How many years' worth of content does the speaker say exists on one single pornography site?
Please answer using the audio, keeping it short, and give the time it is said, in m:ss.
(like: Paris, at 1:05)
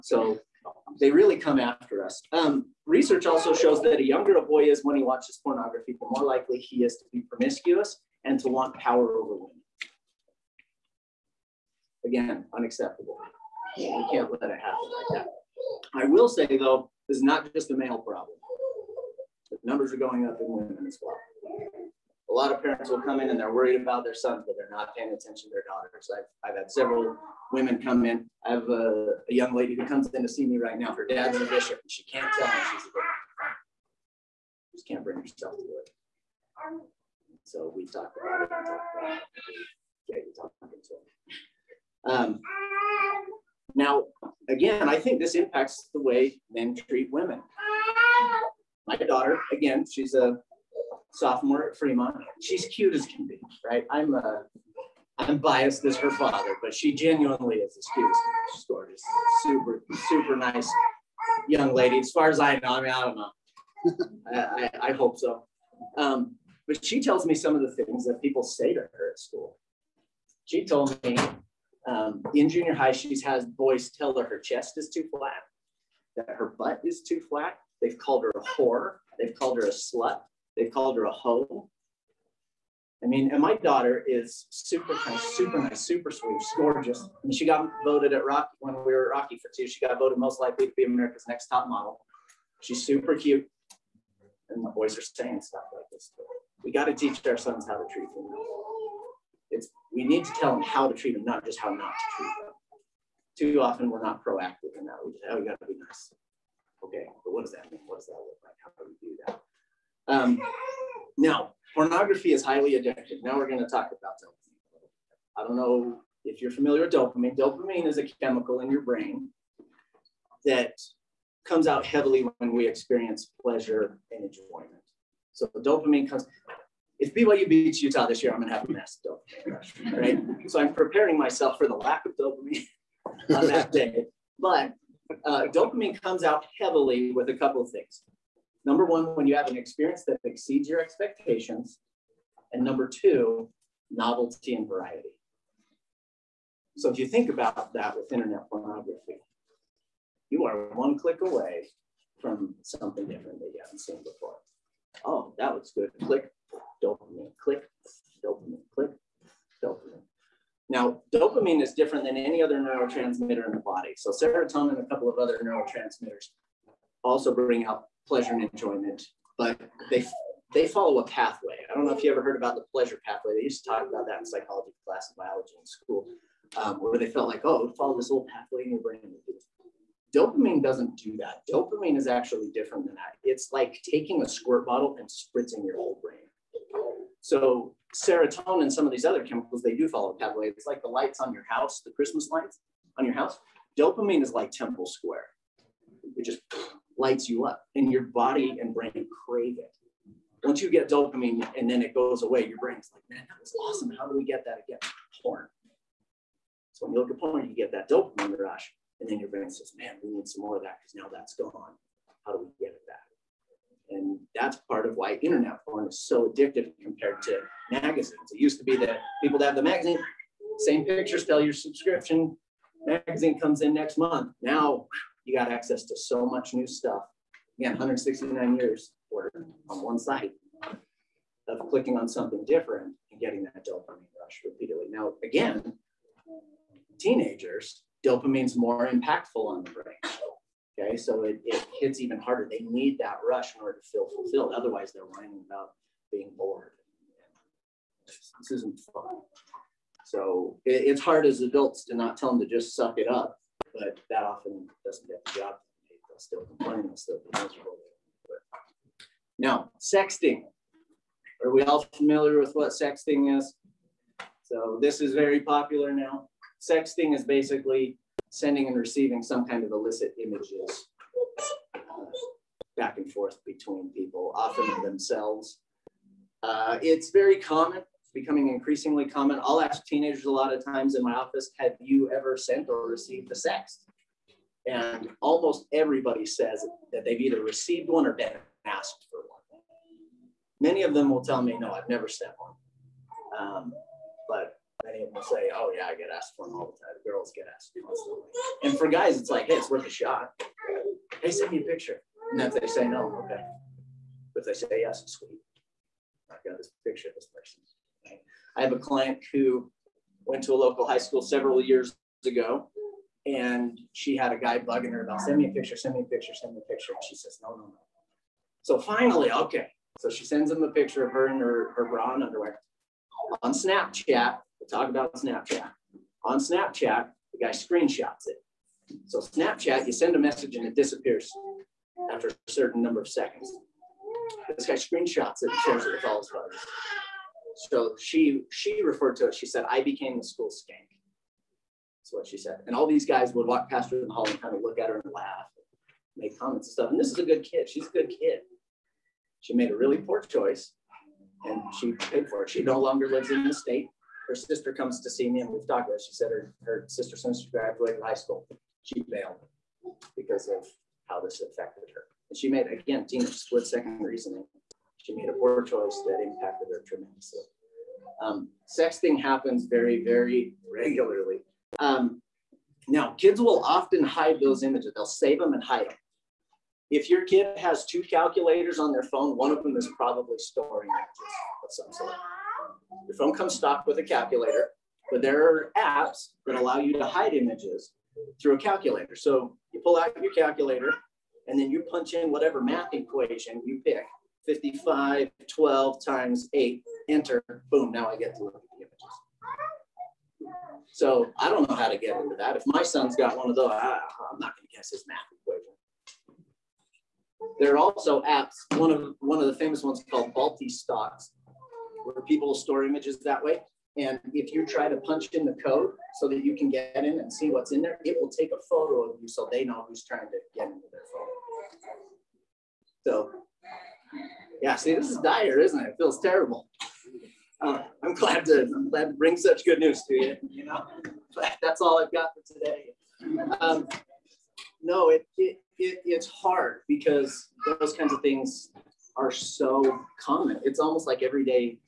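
169, at 3:47.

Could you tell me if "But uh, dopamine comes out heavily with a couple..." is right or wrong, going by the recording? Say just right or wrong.
right.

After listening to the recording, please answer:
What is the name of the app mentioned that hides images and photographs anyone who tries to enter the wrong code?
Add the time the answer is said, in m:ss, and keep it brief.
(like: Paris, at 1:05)
Vaulty Stocks, at 6:50.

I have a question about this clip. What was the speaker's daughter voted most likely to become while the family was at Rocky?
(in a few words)
America's next top model.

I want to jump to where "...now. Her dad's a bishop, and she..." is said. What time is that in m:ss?
0:30.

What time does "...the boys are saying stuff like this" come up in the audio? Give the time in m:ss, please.
1:34.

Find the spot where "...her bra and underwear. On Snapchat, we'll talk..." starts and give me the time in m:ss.
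5:21.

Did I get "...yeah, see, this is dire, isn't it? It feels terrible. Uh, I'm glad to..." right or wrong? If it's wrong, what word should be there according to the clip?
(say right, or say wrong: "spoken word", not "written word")
right.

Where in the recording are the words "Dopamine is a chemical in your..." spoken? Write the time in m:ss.
1:57.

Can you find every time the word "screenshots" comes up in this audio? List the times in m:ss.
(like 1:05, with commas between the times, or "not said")
5:27, 5:34.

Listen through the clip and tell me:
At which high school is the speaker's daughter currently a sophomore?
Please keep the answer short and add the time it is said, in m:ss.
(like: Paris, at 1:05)
Fremont, at 0:49.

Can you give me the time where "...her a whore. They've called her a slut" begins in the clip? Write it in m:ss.
1:18.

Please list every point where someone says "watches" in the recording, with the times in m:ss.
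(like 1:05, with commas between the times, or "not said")
0:05.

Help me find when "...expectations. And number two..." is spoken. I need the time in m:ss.
2:20.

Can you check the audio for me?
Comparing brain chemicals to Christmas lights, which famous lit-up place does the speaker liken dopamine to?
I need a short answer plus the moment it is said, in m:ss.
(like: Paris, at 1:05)
Temple Square, at 3:14.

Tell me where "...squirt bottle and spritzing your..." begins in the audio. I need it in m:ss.
3:04.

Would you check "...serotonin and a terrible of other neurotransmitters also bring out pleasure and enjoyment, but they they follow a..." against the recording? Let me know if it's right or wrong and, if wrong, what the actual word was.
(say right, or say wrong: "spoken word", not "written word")
wrong: "couple", not "terrible".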